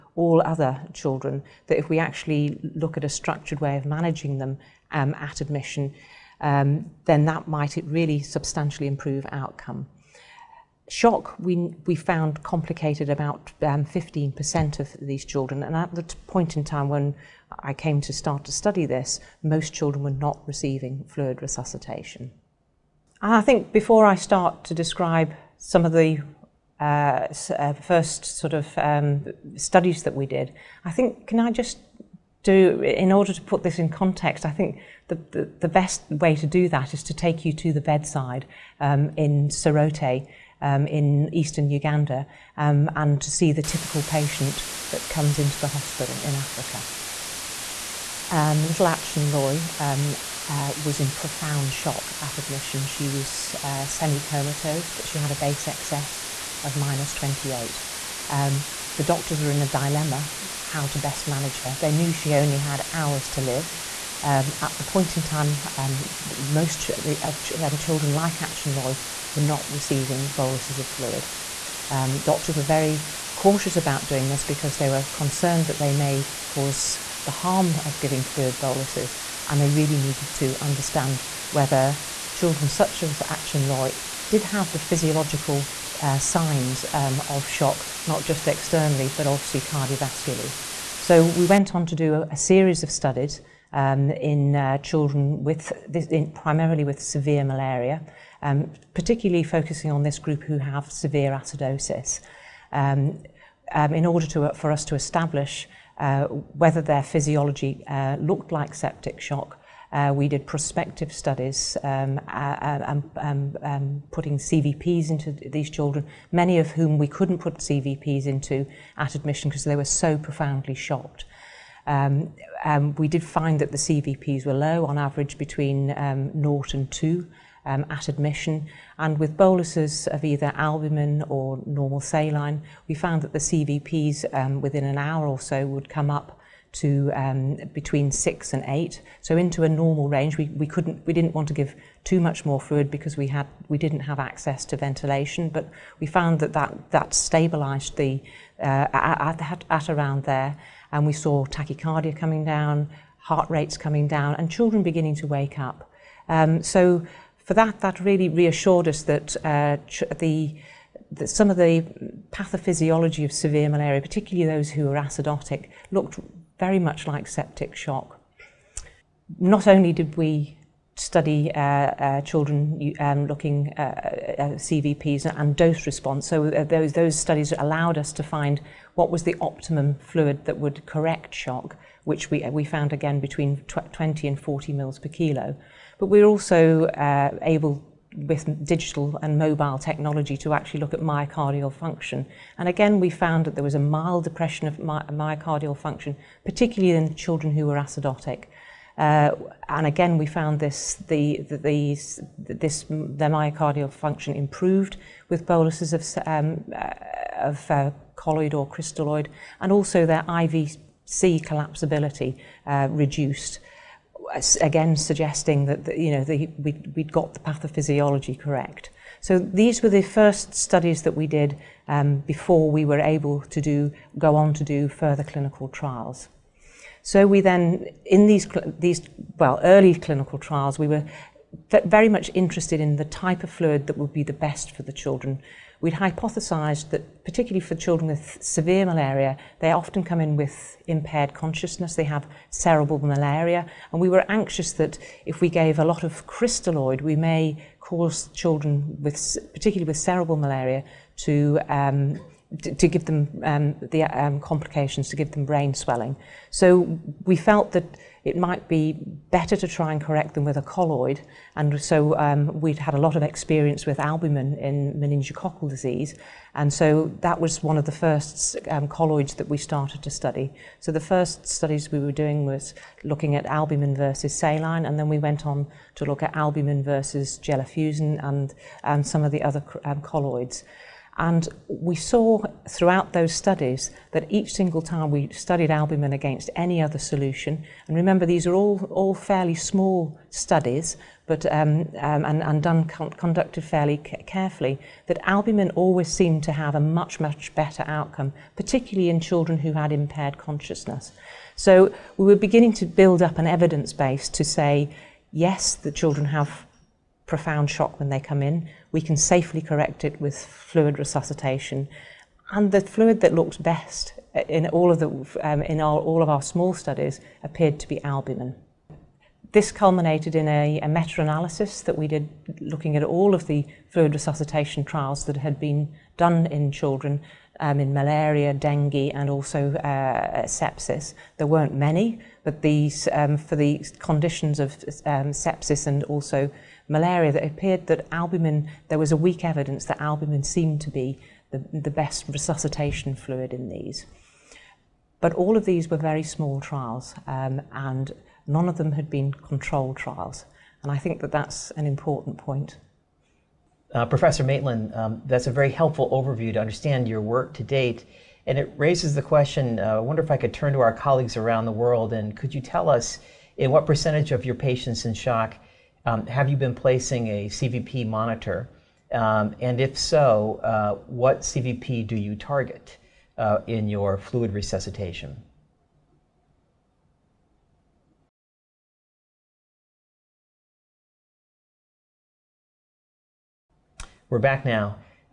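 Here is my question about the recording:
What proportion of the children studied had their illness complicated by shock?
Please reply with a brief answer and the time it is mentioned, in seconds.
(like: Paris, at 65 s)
15%, at 13 s.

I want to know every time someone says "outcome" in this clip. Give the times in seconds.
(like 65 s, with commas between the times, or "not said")
9 s, 297 s.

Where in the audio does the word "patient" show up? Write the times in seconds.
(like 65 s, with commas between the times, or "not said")
44 s, 364 s.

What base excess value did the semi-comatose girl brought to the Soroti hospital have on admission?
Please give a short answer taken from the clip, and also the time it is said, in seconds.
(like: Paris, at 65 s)
-28, at 56 s.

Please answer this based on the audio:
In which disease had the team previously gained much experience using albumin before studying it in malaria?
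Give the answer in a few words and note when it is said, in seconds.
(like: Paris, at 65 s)
Meningococcal disease, at 264 s.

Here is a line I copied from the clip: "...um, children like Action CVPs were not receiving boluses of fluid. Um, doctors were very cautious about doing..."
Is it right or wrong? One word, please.
wrong.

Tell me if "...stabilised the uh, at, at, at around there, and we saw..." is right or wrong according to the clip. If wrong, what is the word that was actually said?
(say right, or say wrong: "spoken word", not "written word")
right.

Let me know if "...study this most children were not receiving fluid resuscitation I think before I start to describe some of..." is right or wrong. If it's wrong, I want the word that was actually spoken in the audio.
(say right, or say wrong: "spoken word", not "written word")
right.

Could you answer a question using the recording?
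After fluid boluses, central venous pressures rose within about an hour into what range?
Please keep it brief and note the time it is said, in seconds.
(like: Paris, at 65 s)
6 to 8, at 137 s.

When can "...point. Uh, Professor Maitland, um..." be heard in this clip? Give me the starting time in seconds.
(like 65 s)
352 s.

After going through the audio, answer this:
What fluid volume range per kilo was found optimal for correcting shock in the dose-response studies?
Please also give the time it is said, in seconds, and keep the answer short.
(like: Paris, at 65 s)
20 to 40 ml/kg, at 183 s.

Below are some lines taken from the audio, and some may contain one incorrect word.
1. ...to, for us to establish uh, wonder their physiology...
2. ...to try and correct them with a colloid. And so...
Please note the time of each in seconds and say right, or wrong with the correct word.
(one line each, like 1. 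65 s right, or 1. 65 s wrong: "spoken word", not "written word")
1. 104 s wrong: "whether", not "wonder"
2. 259 s right.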